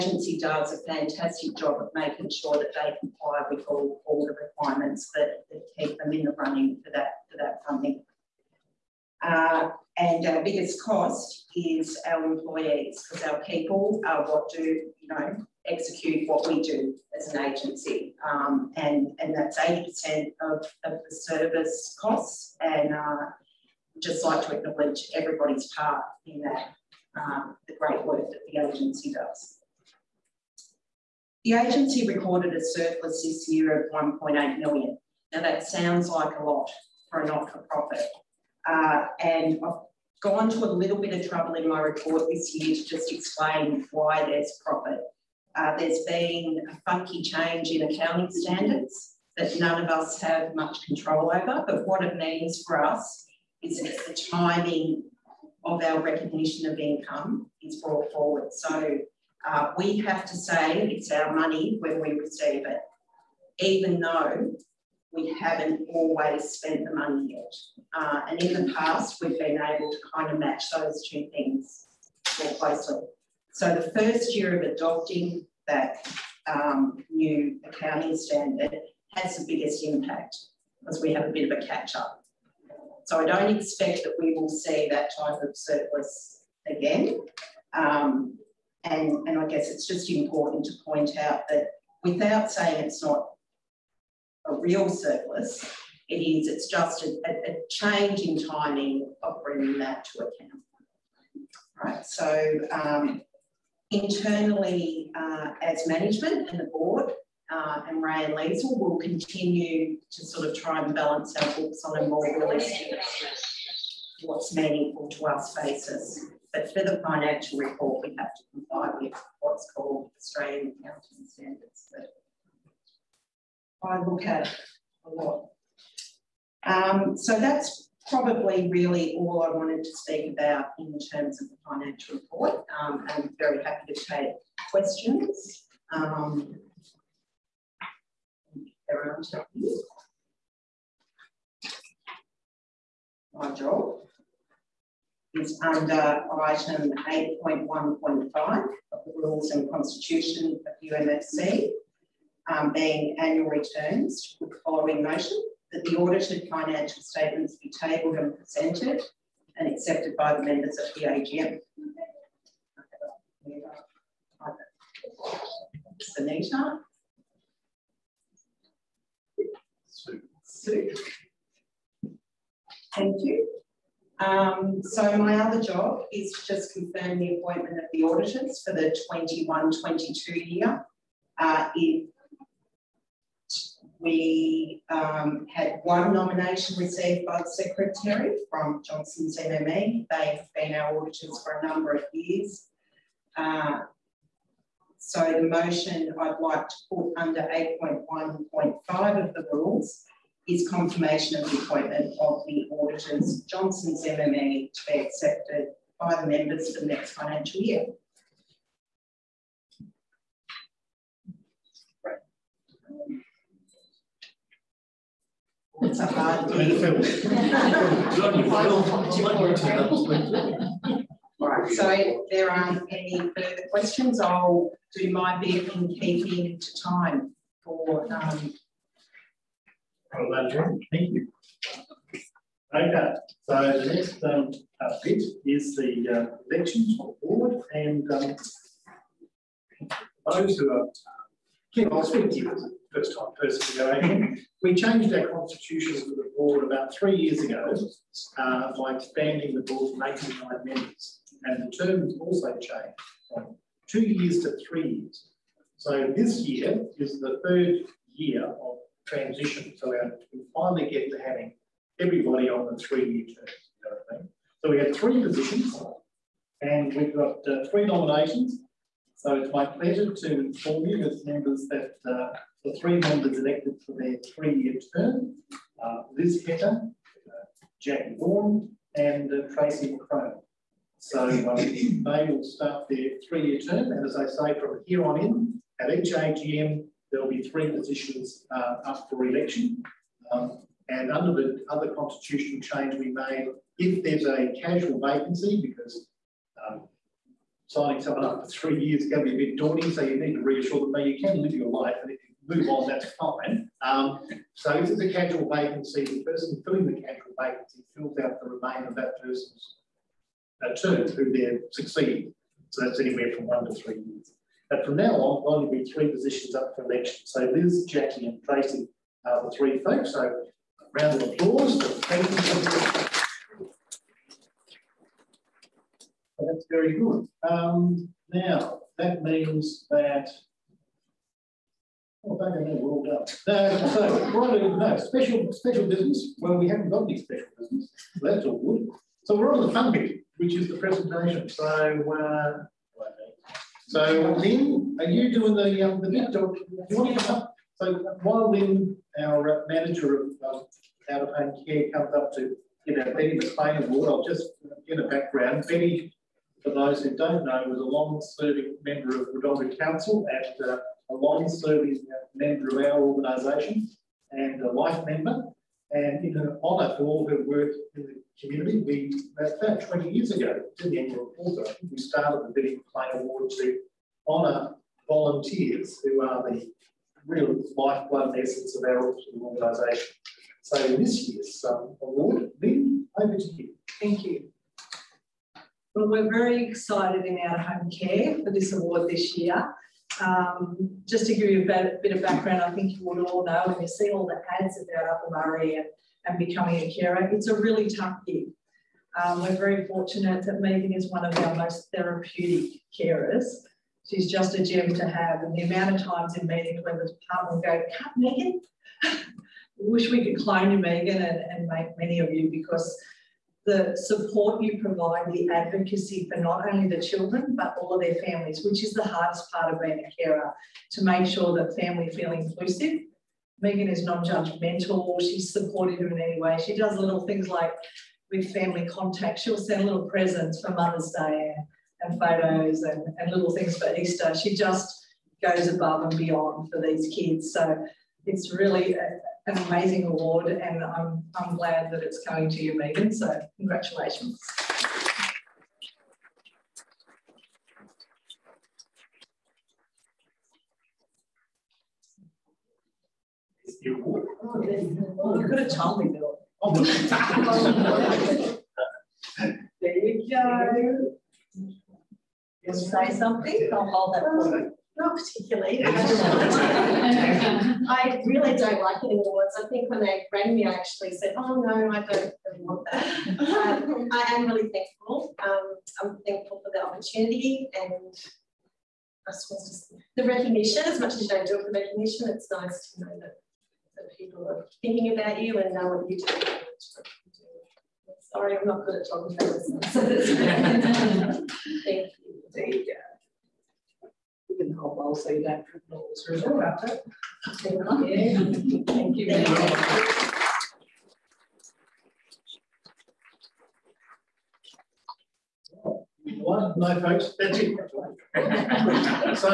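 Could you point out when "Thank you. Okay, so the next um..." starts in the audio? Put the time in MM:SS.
03:50.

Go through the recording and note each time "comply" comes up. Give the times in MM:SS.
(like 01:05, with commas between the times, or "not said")
00:02, 01:58.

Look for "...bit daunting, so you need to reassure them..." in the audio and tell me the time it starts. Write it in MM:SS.
04:59.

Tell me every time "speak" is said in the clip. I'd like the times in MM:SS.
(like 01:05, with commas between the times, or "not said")
02:09, 04:02.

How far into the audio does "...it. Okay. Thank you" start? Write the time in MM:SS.
08:16.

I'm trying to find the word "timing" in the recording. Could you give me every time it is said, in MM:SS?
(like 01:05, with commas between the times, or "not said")
00:54, 01:38.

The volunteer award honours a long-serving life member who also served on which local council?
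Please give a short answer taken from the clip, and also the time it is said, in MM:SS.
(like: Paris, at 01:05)
Wodonga Council, at 05:59.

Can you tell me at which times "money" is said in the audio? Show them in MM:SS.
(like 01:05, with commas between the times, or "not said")
01:01, 01:06.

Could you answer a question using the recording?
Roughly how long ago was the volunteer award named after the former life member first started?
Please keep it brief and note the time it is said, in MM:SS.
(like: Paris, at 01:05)
20 years ago, at 06:09.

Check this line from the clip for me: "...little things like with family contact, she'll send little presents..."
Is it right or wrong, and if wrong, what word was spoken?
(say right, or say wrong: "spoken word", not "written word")
right.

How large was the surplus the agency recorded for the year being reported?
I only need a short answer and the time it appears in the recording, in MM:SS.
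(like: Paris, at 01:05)
1.8 million, at 00:33.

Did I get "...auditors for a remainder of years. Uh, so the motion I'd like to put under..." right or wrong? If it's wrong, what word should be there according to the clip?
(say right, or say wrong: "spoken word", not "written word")
wrong: "number", not "remainder".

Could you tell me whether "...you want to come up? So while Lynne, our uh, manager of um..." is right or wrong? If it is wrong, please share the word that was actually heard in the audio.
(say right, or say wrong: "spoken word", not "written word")
right.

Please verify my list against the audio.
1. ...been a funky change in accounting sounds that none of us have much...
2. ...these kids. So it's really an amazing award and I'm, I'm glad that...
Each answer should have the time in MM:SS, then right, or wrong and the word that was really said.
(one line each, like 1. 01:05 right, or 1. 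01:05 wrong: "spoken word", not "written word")
1. 00:46 wrong: "standards", not "sounds"
2. 07:16 right.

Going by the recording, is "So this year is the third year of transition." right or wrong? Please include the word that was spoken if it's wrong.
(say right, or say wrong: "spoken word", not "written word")
right.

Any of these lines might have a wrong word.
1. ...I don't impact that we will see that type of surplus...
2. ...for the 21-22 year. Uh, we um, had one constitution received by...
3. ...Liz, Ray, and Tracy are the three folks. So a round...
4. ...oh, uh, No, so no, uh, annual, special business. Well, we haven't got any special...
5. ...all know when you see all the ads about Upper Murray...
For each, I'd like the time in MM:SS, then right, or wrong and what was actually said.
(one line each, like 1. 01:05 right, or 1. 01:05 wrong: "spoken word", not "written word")
1. 01:23 wrong: "expect", not "impact"
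2. 02:58 wrong: "nomination", not "constitution"
3. 05:17 wrong: "Jackie", not "Ray"
4. 05:33 wrong: "special", not "annual"
5. 06:33 right.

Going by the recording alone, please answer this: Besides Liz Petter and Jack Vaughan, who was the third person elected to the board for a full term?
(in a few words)
Tracy McCrone.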